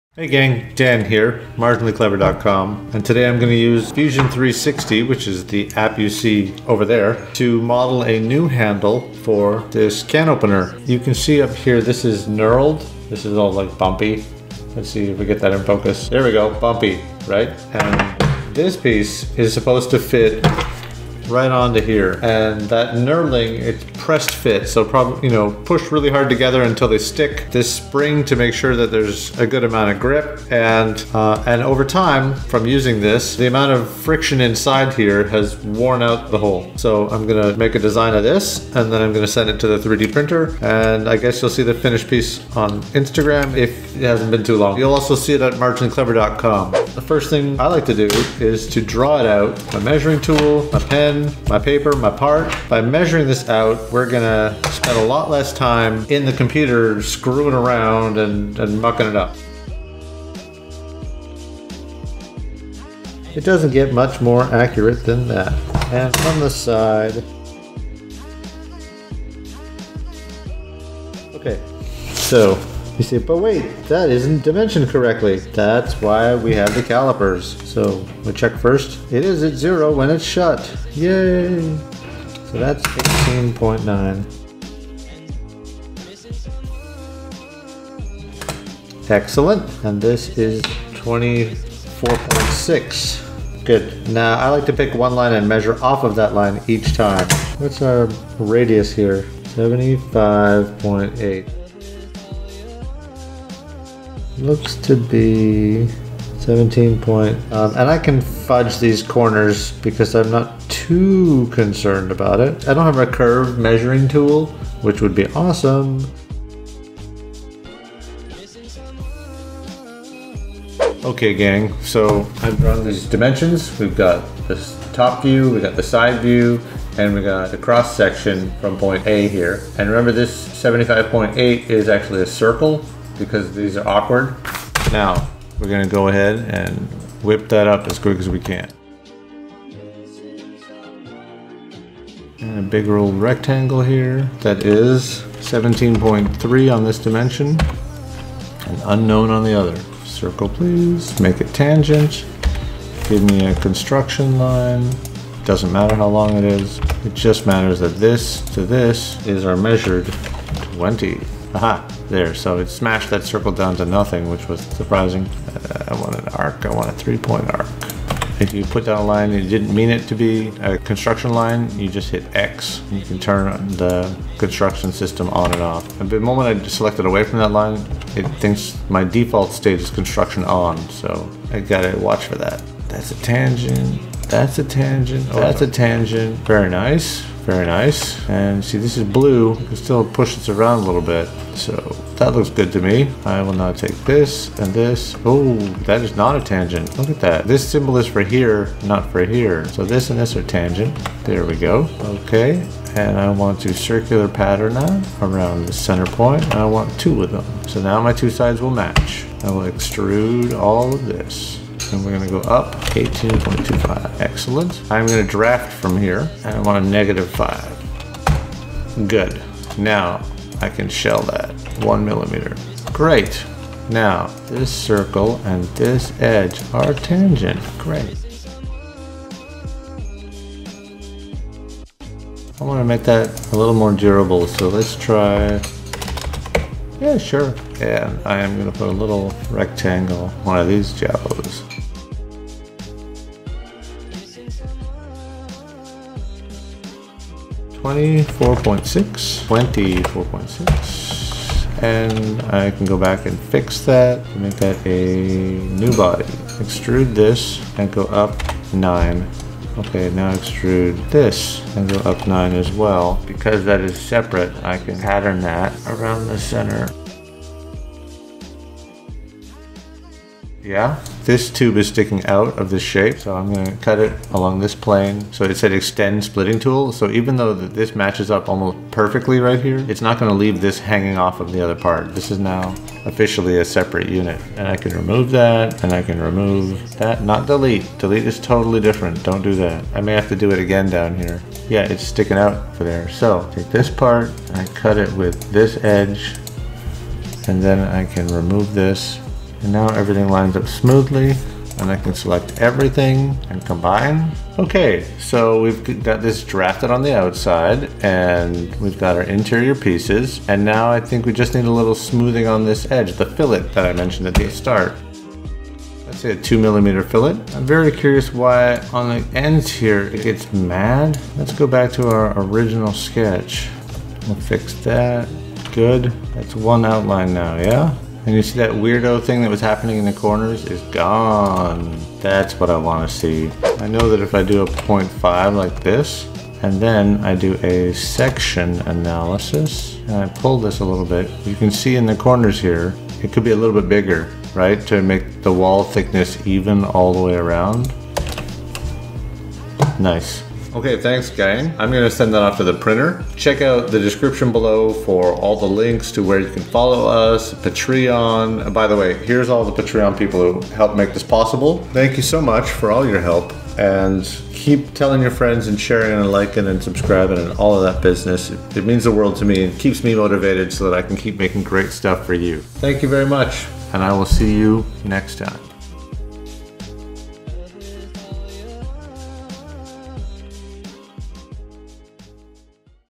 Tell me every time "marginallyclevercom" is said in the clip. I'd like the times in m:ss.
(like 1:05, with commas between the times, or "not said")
0:01, 0:45.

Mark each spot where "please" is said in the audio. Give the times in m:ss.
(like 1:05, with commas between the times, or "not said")
2:30.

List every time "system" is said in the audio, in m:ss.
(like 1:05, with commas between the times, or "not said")
2:54.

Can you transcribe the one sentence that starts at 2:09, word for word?
And remember this 75.8 is actually a circle because these are awkward.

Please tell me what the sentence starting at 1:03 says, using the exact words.
It doesn't get much more accurate than that.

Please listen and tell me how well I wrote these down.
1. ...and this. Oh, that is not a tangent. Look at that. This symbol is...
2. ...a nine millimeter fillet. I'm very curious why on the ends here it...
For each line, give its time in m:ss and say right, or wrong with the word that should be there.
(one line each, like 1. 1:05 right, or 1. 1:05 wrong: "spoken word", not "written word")
1. 3:14 right
2. 5:16 wrong: "two", not "nine".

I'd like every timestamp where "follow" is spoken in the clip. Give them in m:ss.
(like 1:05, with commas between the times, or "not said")
5:56.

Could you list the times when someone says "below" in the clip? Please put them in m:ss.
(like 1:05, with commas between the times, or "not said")
5:54.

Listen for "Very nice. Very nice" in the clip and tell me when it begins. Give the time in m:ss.
3:06.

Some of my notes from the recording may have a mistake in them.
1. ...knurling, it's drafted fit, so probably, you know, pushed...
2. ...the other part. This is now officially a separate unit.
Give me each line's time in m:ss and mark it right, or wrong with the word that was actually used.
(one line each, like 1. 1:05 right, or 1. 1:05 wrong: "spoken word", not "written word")
1. 0:22 wrong: "pressed", not "drafted"
2. 4:41 right.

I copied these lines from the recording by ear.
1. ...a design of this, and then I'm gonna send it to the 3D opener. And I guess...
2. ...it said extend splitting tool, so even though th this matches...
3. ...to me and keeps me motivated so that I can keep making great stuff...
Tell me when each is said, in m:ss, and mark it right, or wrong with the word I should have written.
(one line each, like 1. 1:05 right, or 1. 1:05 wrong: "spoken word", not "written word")
1. 0:37 wrong: "printer", not "opener"
2. 4:35 right
3. 6:09 right.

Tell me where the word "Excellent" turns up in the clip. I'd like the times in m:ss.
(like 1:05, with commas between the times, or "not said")
1:29, 3:34.